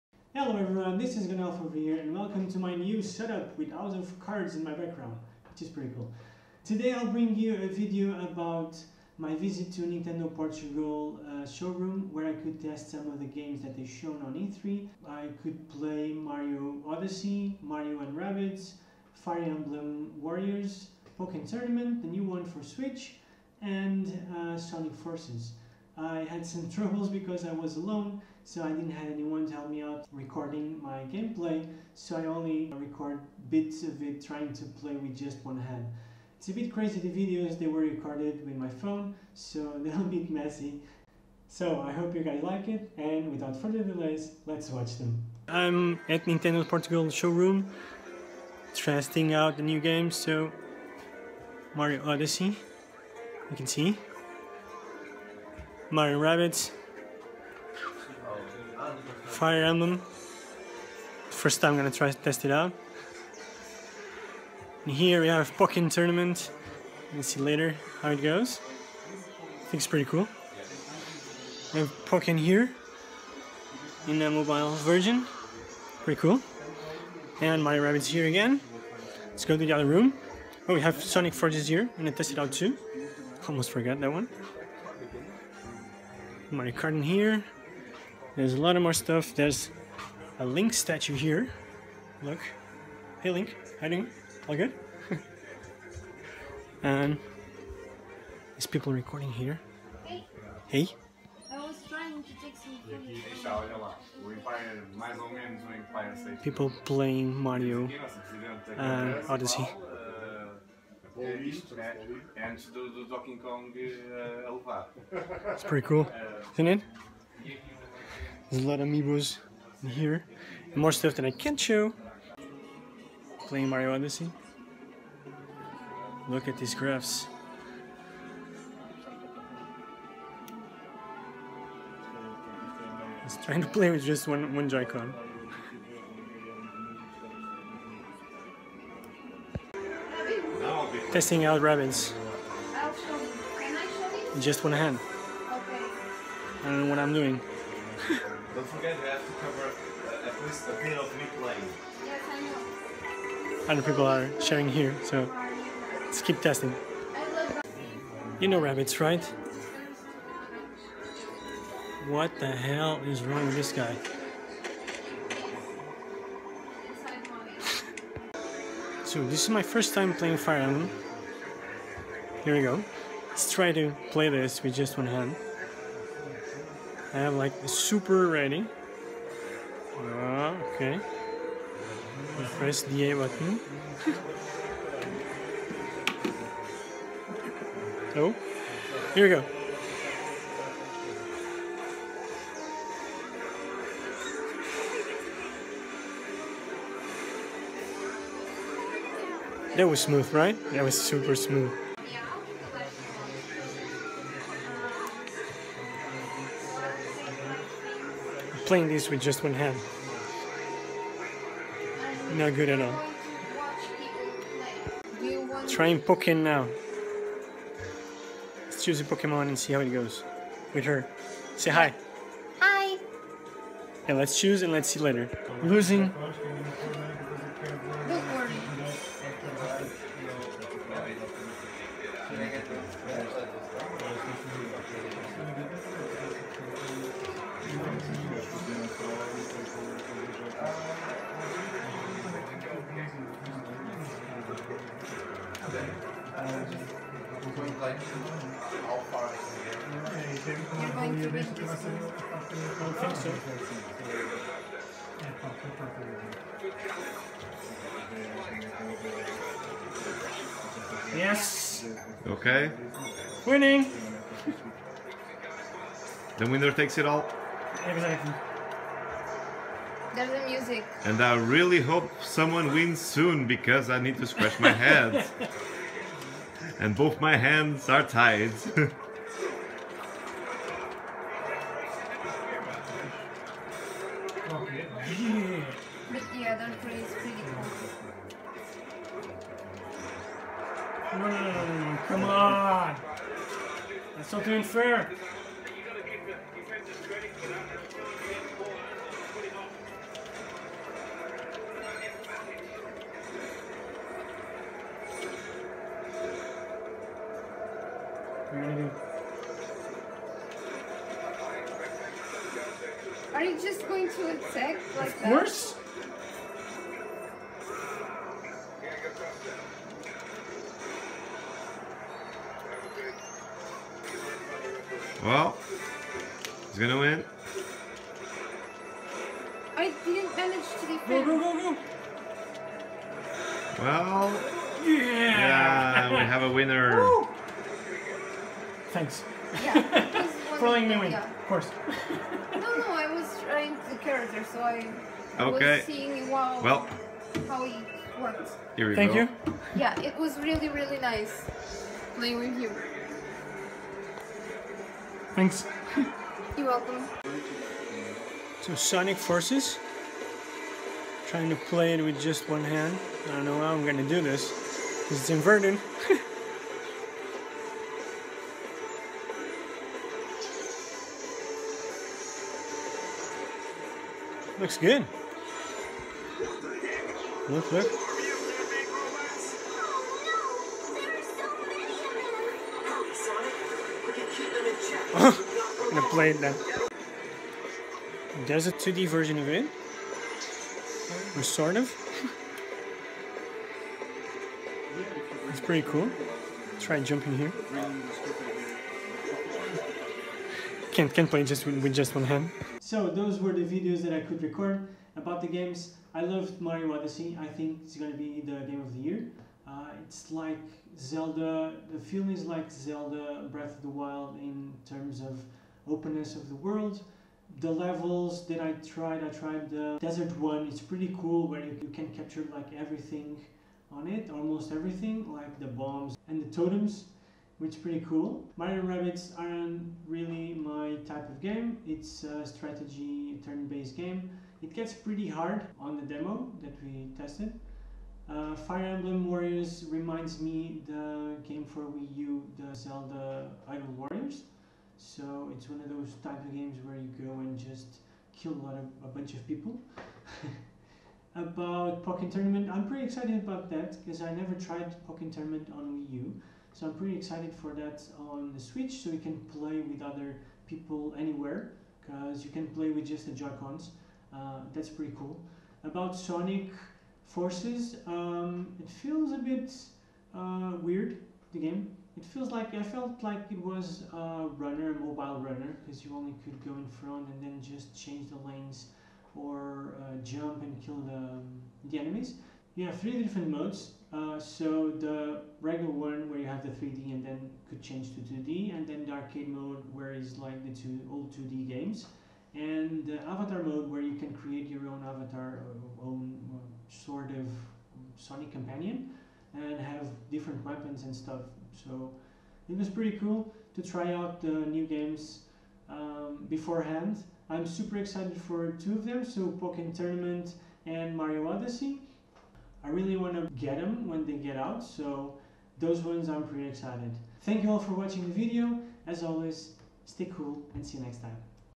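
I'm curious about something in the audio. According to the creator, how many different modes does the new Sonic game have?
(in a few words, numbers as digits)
3.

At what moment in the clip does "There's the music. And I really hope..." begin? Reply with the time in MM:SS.
04:30.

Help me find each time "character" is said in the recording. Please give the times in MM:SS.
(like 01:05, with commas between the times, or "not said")
05:43.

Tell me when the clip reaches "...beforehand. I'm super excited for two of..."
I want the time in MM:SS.
08:26.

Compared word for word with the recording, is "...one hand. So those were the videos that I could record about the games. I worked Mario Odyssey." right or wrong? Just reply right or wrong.
wrong.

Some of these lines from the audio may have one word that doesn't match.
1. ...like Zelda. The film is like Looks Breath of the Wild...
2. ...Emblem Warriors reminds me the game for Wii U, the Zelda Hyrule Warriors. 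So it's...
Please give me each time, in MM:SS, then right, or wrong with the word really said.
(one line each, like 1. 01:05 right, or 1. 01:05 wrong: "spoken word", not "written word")
1. 06:50 wrong: "Zelda", not "Looks"
2. 07:18 right.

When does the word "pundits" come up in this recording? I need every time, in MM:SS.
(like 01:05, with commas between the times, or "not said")
not said.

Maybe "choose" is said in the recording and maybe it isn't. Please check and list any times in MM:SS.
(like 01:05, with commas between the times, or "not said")
03:38, 03:44.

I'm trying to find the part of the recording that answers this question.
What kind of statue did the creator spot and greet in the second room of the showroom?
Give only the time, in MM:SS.
01:30.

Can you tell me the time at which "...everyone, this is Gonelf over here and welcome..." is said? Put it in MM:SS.
00:00.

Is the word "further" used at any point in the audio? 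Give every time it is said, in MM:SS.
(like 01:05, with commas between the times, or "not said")
00:43.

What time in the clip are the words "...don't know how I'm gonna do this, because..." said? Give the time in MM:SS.
06:03.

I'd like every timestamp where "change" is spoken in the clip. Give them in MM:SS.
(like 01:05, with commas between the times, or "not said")
07:57, 08:07.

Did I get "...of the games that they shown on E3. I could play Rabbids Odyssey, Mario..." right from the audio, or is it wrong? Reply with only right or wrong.
wrong.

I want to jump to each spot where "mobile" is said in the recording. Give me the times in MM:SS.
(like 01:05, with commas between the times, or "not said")
01:14, 07:54.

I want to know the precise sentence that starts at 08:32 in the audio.
I really want to get them when they get out, so those ones I'm pretty excited.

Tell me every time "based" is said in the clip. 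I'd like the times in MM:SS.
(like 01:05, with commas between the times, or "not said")
07:13.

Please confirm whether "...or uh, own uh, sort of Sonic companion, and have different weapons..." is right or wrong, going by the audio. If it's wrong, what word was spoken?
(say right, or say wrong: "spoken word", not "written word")
right.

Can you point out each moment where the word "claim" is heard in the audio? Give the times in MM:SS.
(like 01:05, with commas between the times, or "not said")
not said.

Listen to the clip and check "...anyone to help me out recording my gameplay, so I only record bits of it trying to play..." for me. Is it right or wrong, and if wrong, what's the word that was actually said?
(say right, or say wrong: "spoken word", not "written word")
right.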